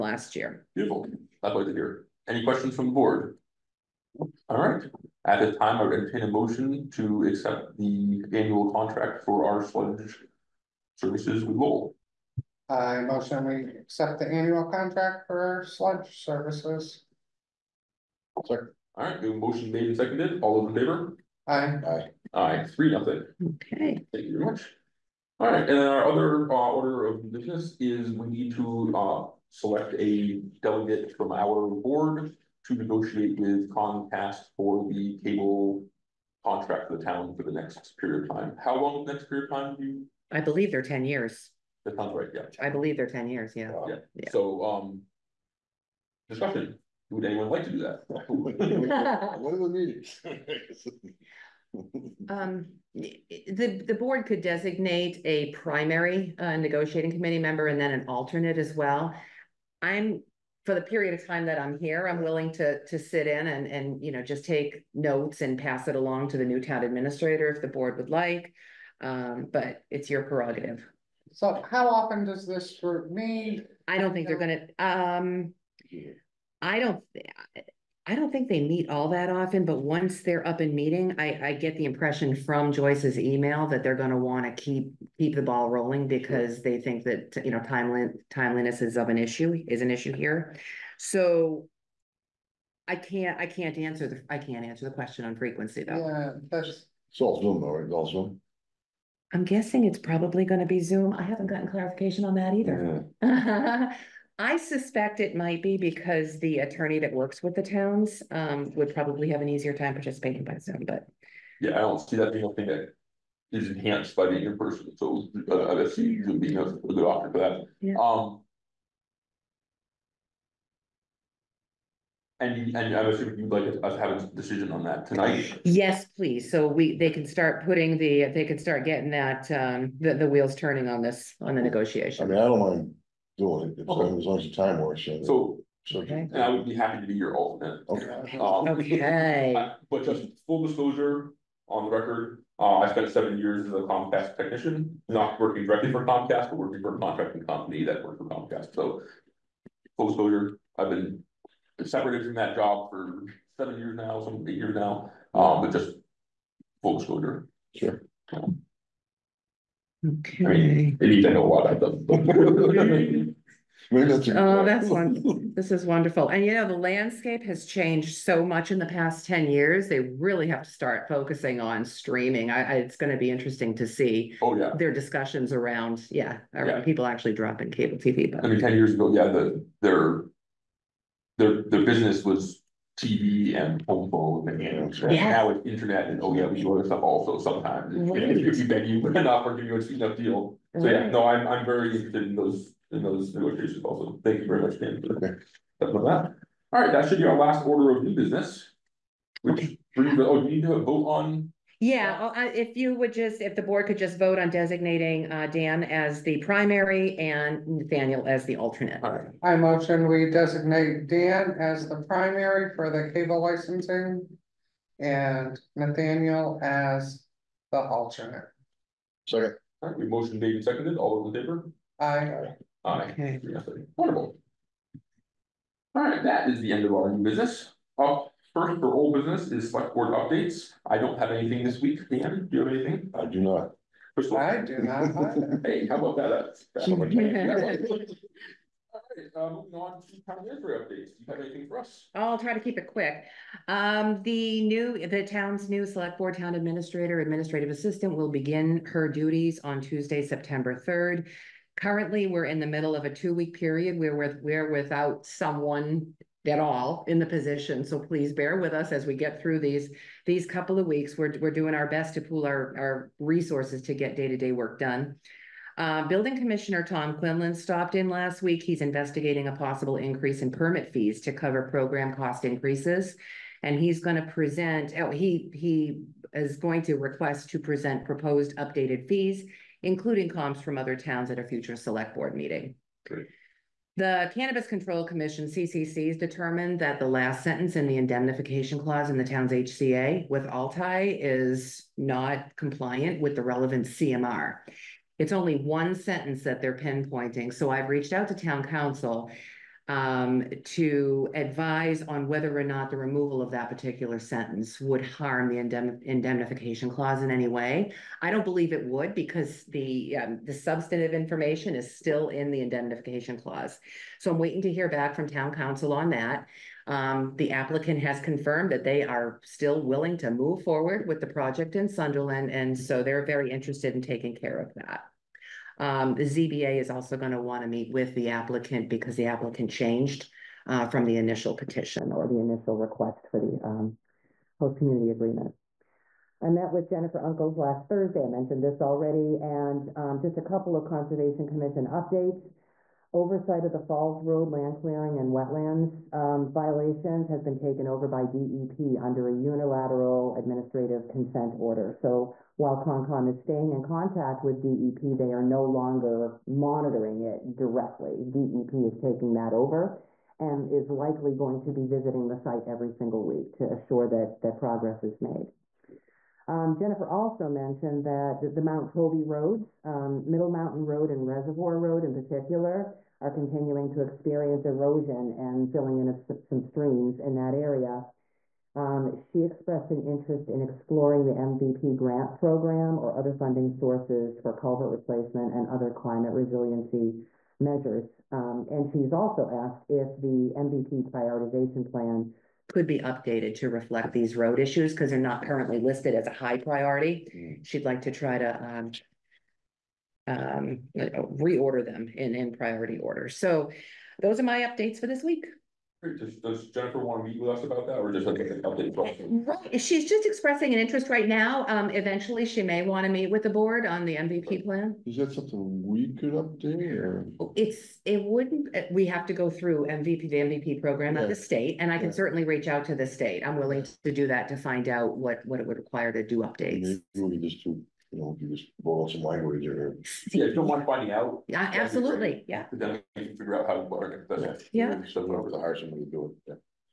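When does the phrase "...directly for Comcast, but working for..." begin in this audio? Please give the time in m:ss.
2:25.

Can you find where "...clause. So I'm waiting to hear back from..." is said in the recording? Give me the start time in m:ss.
5:13.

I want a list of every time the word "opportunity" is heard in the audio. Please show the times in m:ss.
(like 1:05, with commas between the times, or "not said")
3:09.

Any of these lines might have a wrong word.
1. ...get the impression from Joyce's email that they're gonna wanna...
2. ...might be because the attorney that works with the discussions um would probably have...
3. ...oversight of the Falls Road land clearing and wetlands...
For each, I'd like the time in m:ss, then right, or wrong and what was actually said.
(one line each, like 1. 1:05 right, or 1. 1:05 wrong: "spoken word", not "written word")
1. 1:21 right
2. 1:45 wrong: "towns", not "discussions"
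3. 5:43 right.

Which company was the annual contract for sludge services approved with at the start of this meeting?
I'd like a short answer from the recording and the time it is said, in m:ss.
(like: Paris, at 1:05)
Lowell, at 0:11.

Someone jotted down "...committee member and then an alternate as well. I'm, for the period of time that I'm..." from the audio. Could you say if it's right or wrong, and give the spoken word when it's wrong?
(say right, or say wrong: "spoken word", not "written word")
right.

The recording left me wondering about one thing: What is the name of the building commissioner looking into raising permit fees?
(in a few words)
Tom Quinlan.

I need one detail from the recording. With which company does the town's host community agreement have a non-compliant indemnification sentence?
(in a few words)
Altai.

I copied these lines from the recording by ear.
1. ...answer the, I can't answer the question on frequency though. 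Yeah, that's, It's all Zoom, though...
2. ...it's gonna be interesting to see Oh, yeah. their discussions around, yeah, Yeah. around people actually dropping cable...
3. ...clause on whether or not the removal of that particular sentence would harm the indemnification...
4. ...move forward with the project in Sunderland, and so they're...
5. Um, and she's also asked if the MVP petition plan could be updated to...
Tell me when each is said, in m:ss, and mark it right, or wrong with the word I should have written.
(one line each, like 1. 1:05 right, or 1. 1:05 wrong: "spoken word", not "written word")
1. 1:33 right
2. 2:52 right
3. 5:01 wrong: "advise", not "clause"
4. 5:20 right
5. 6:28 wrong: "prioritization", not "petition".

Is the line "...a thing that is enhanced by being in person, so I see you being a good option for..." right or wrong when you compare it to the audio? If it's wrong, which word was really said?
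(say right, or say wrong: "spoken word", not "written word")
right.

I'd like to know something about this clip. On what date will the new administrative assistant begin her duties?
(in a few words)
Tuesday, September 3.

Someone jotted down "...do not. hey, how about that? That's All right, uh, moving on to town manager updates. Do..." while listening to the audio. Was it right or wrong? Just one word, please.
right.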